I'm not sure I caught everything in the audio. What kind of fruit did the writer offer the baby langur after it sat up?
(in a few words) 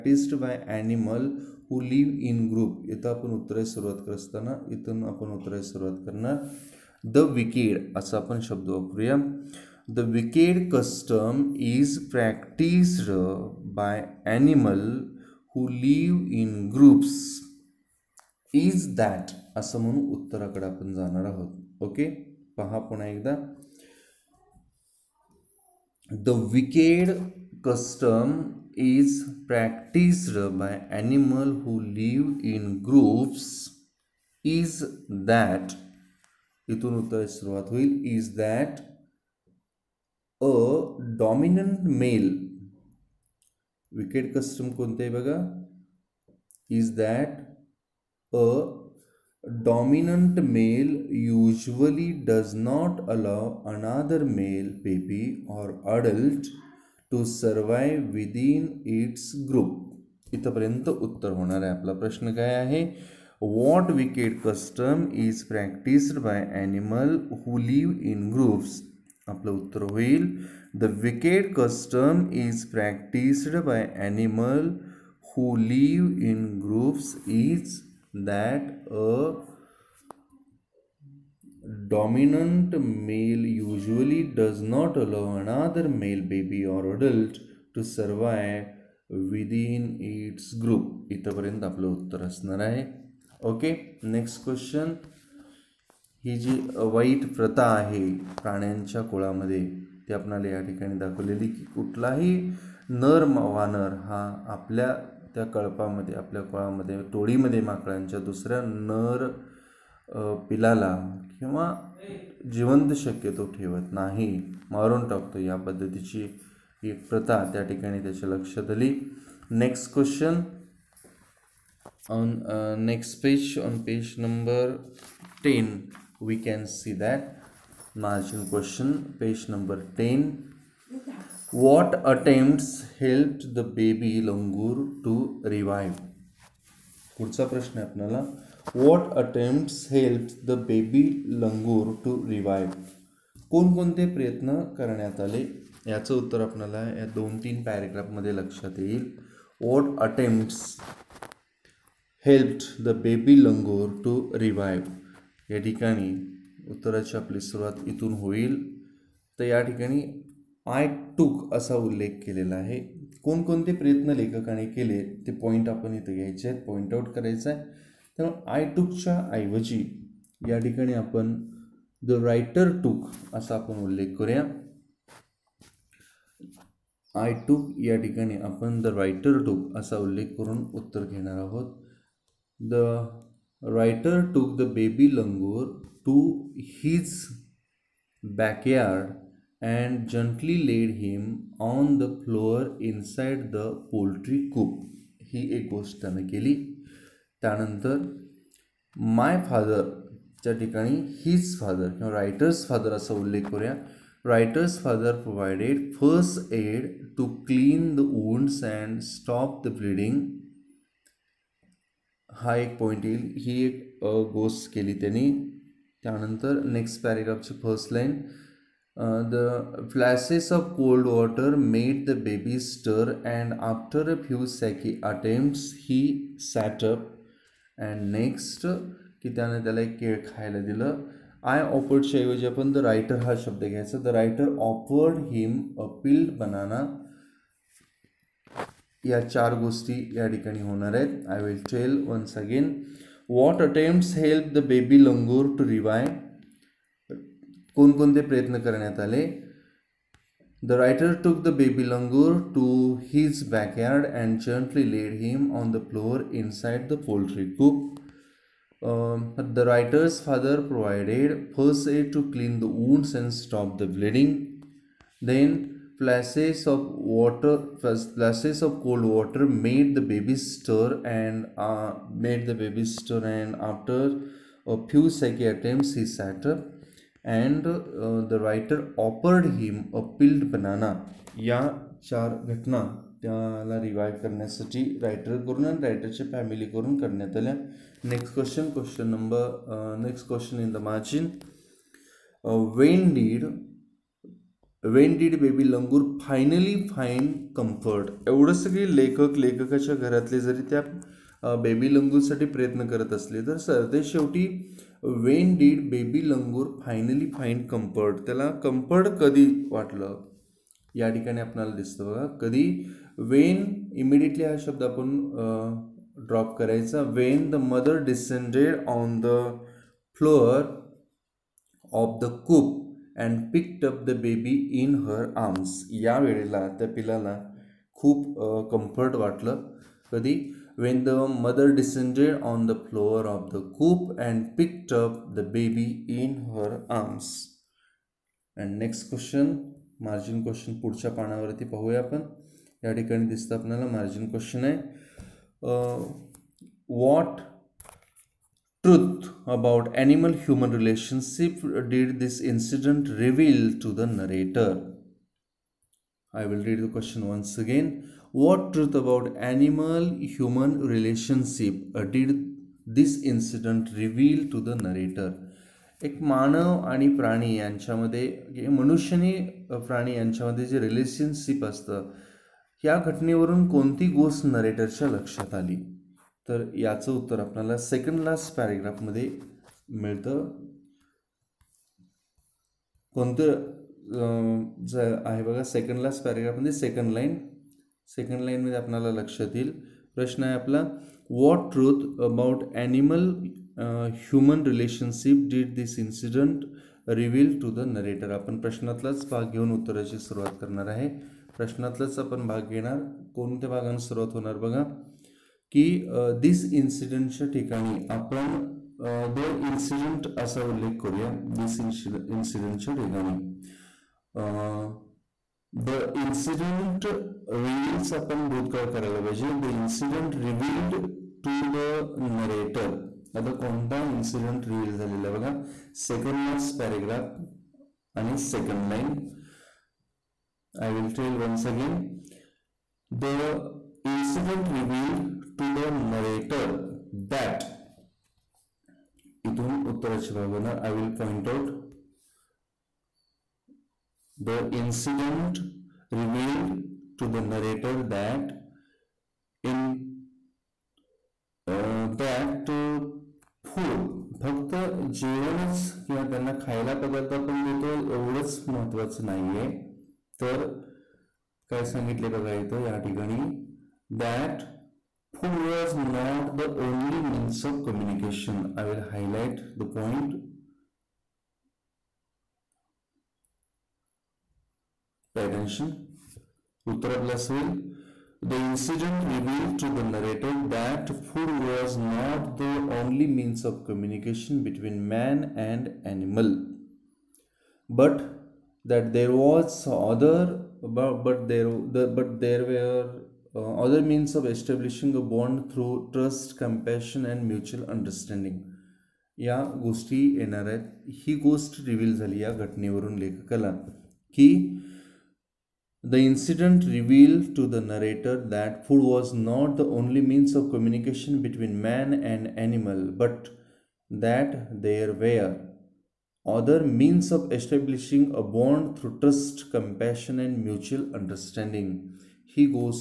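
Peeled banana.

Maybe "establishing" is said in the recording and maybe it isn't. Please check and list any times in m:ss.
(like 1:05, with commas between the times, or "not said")
8:14, 8:37.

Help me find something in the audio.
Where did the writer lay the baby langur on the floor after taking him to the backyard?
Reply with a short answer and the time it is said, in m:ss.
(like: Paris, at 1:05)
Inside the poultry coop, at 3:12.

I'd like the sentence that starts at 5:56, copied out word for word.
I will read the question once again.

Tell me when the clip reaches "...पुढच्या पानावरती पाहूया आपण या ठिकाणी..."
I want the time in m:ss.
5:40.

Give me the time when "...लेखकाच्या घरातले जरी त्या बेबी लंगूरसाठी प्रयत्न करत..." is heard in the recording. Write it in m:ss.
4:59.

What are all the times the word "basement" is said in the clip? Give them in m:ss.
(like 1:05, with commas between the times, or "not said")
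not said.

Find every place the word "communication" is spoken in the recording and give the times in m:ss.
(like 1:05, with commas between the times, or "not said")
7:47, 8:03.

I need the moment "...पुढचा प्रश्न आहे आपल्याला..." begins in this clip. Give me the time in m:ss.
2:17.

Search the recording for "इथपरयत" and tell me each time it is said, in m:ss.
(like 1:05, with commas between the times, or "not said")
1:00, 1:31.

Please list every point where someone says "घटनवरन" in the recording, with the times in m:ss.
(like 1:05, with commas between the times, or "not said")
6:13, 8:22.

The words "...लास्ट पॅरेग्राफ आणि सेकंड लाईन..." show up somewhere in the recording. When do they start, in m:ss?
7:06.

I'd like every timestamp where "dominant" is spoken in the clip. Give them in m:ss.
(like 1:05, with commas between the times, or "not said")
1:21.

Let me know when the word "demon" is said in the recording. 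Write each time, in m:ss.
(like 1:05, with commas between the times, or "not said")
not said.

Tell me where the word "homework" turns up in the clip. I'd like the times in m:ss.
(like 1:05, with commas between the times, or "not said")
not said.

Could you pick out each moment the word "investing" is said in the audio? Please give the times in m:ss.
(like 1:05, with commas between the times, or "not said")
not said.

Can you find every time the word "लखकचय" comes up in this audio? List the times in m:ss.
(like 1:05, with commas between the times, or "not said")
4:59.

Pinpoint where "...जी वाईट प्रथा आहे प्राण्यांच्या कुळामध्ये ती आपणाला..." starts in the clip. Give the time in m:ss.
1:36.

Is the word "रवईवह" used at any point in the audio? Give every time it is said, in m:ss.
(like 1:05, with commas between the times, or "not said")
2:22, 2:34.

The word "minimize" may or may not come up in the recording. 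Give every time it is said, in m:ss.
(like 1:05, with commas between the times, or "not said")
not said.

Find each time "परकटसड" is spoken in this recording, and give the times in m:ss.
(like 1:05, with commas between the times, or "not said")
0:12, 0:29, 1:05, 1:12.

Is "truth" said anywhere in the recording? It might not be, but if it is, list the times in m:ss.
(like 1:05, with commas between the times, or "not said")
5:48, 5:58.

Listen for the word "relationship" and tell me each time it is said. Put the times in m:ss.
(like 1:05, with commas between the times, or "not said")
5:50, 6:00.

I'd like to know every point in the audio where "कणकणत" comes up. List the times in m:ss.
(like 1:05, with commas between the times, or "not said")
2:23, 2:43.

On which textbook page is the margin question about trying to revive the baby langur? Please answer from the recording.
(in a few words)
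10.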